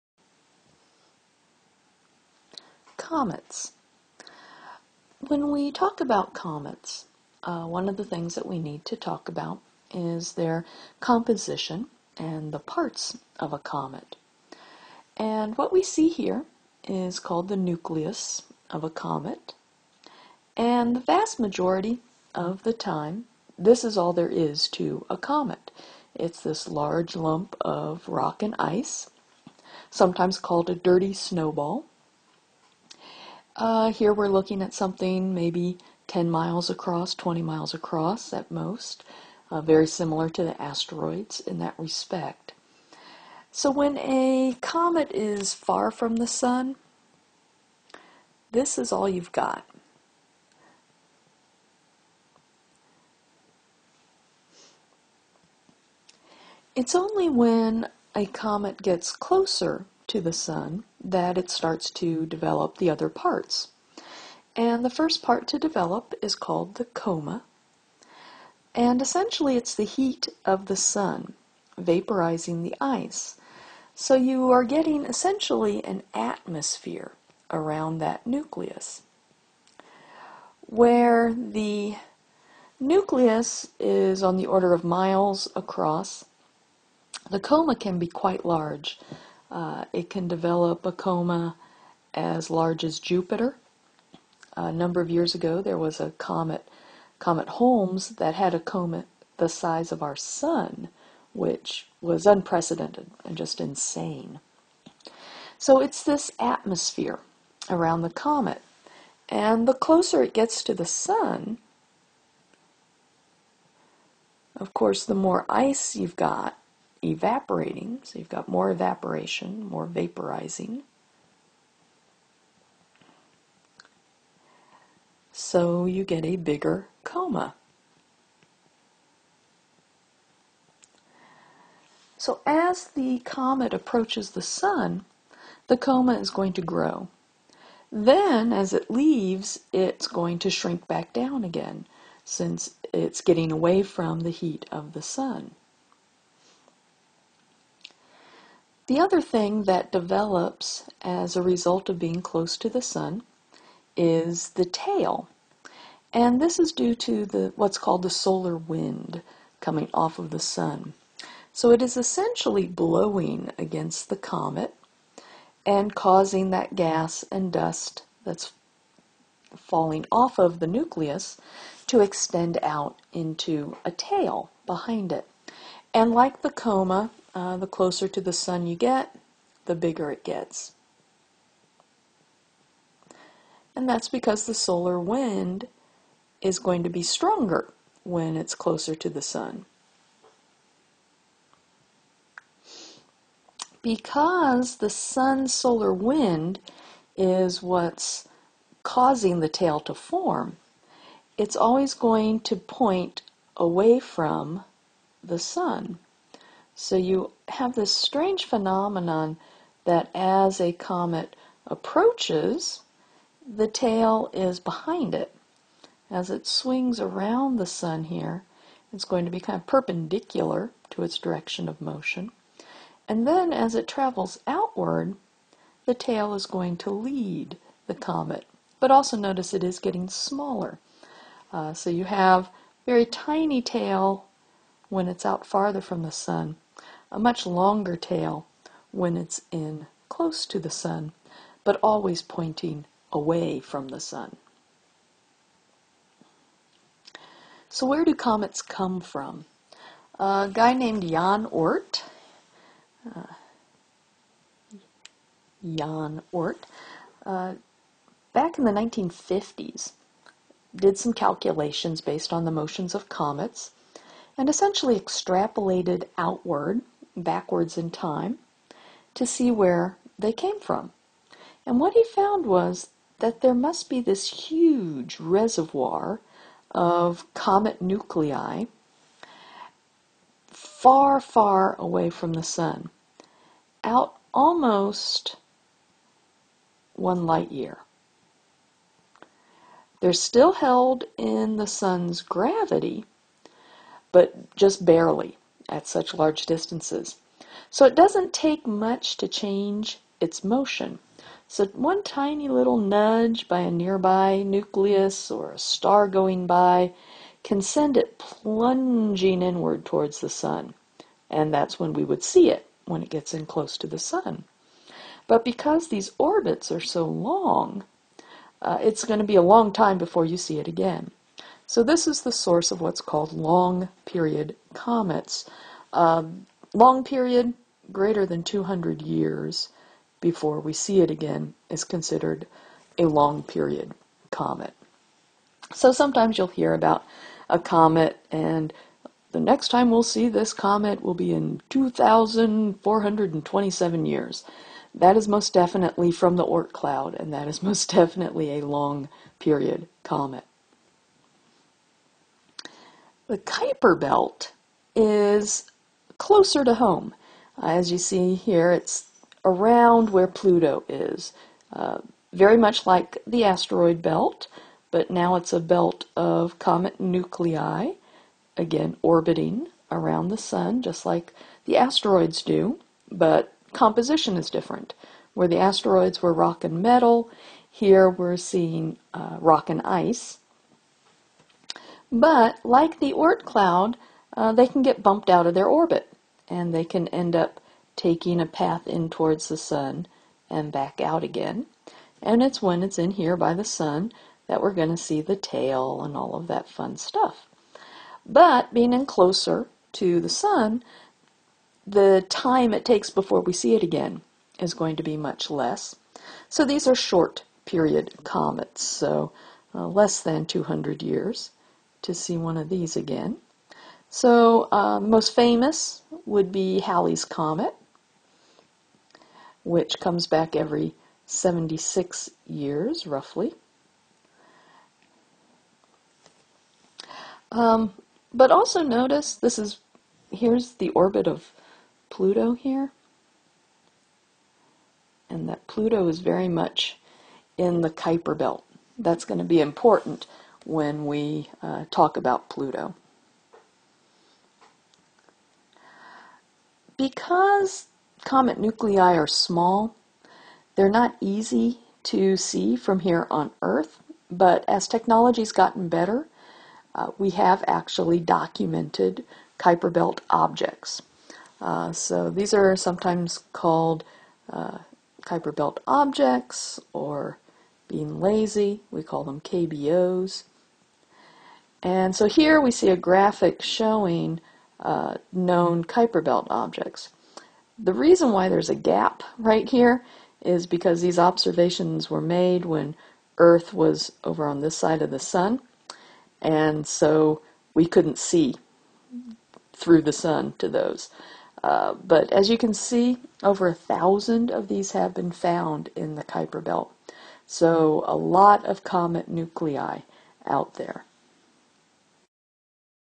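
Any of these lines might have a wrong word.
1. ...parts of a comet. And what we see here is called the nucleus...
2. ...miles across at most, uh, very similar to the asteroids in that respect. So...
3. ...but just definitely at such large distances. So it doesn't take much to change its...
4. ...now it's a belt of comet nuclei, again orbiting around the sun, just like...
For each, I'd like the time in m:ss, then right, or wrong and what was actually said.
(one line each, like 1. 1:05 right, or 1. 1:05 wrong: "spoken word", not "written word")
1. 0:12 right
2. 0:37 right
3. 4:54 wrong: "barely", not "definitely"
4. 6:05 right.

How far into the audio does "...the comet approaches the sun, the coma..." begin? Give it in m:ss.
2:12.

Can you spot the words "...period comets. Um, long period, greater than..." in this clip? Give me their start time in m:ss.
5:24.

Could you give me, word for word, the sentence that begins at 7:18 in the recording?
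That's going to be important when we uh, talk about Pluto.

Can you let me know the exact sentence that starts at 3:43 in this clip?
And then as it travels outward, the tail is going to lead the comet.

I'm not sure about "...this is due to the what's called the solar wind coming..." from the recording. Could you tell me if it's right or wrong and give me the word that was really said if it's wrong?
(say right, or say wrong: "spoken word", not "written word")
right.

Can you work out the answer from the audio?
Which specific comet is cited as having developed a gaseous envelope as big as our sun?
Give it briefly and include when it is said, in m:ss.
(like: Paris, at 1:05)
Comet Holmes, at 1:37.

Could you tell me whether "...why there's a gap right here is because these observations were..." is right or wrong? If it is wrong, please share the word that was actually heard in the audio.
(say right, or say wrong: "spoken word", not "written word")
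right.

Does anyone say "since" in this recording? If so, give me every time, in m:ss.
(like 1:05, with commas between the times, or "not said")
2:22.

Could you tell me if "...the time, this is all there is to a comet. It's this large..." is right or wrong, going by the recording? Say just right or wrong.
right.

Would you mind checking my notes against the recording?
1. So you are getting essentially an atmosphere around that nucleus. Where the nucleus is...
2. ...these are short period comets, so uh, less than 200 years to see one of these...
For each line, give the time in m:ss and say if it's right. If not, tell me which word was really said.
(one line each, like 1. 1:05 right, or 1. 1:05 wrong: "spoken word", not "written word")
1. 1:13 right
2. 6:46 right.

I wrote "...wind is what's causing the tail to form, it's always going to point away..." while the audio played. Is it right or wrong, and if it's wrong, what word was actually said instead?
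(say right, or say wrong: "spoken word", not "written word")
right.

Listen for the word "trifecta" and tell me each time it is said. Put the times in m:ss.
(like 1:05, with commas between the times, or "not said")
not said.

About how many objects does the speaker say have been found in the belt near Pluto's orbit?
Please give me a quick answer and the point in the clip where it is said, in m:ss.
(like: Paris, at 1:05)
over 1,000, at 8:13.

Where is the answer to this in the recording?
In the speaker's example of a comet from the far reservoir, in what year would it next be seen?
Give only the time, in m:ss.
5:41.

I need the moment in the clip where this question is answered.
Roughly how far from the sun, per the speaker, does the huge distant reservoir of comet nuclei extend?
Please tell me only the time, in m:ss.
4:44.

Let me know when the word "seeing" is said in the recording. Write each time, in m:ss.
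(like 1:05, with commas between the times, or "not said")
6:18.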